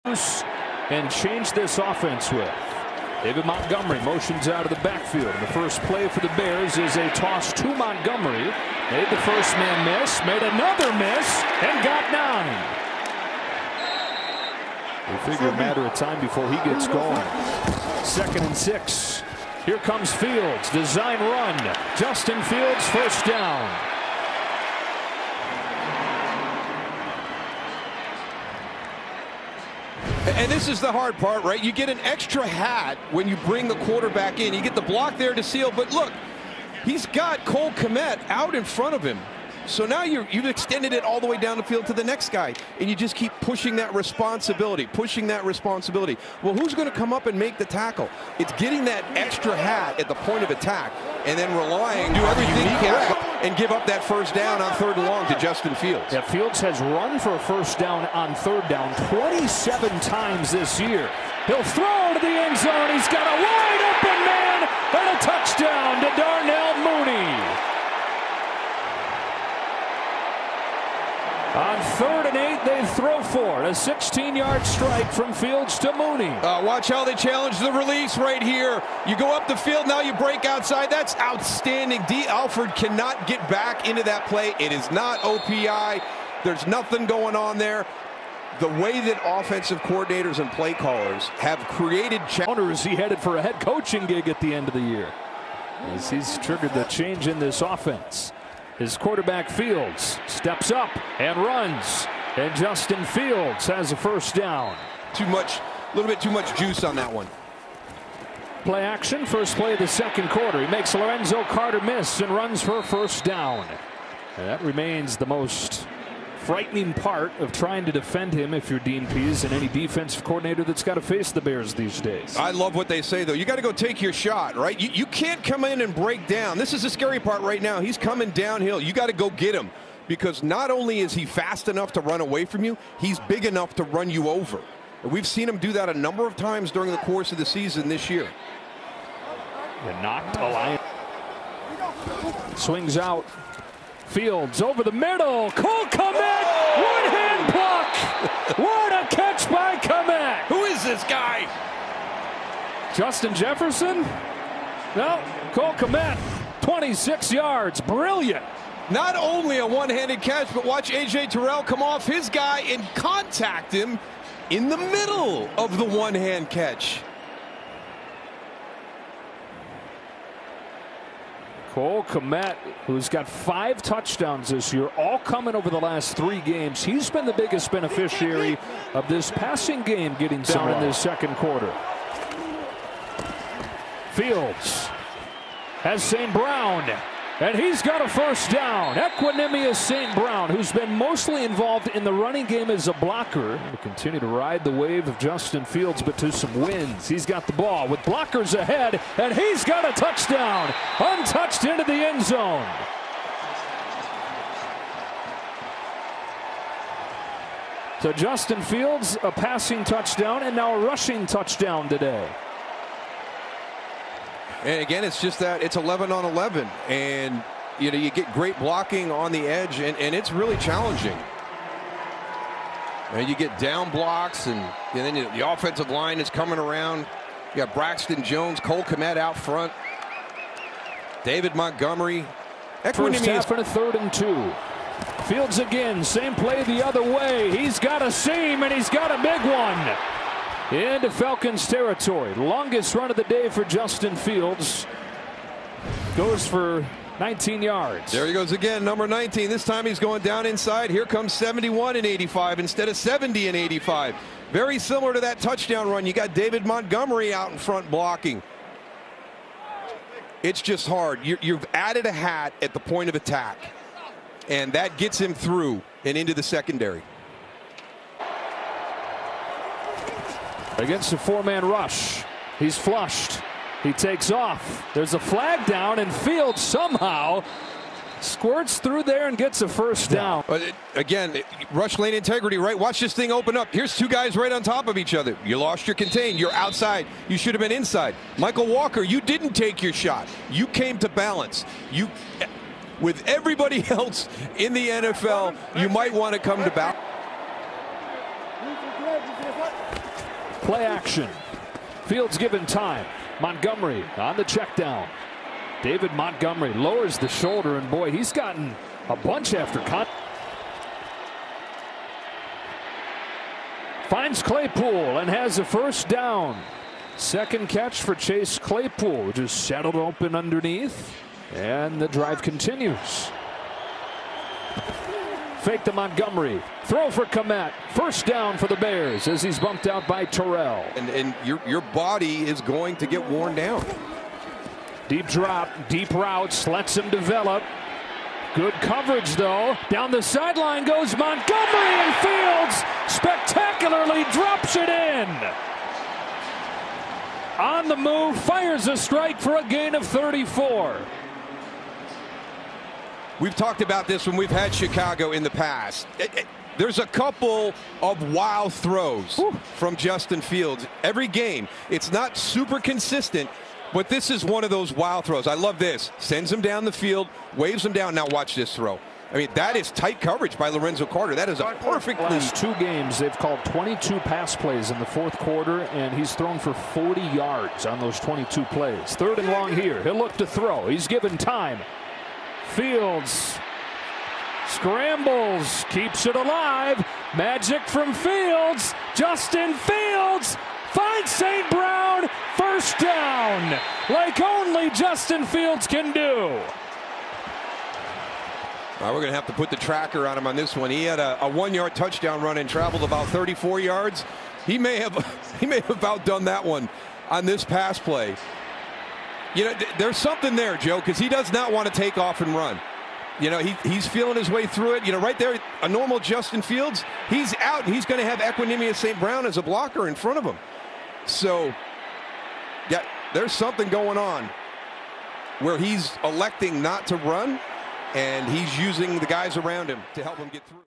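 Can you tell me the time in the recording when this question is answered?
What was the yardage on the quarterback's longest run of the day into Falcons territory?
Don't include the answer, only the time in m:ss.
4:07.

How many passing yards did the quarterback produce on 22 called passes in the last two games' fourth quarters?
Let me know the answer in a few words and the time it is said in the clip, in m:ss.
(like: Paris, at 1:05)
40, at 6:16.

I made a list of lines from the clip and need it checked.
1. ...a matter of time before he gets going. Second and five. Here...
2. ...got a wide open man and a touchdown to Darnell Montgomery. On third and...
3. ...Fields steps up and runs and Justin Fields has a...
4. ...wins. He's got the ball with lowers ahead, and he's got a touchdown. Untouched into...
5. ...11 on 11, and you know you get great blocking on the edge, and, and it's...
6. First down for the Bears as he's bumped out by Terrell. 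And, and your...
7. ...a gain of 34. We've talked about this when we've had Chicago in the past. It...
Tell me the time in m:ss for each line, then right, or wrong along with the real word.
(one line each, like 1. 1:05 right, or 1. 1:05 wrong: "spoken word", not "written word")
1. 0:15 wrong: "six", not "five"
2. 1:03 wrong: "Mooney", not "Montgomery"
3. 1:39 right
4. 3:16 wrong: "blockers", not "lowers"
5. 3:35 right
6. 5:27 right
7. 5:49 right.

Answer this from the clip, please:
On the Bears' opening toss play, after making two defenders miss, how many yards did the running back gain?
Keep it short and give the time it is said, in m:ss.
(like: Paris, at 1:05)
9, at 0:11.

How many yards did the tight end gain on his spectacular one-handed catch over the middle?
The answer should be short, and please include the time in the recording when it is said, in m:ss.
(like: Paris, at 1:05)
26, at 2:36.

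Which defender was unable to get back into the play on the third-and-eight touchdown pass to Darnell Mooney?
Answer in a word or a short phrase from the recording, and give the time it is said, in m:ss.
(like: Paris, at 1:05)
Dee Alford, at 1:22.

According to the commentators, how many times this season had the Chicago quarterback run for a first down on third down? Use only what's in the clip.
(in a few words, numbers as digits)
27.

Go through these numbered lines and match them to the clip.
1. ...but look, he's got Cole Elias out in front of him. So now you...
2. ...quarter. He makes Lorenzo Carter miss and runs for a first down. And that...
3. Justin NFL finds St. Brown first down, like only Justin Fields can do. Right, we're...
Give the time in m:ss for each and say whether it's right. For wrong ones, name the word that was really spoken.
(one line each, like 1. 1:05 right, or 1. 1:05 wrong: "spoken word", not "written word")
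1. 0:35 wrong: "Kmet", not "Elias"
2. 1:50 right
3. 6:29 wrong: "Fields", not "NFL".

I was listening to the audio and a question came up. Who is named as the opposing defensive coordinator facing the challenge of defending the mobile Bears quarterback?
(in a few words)
Dean Pees.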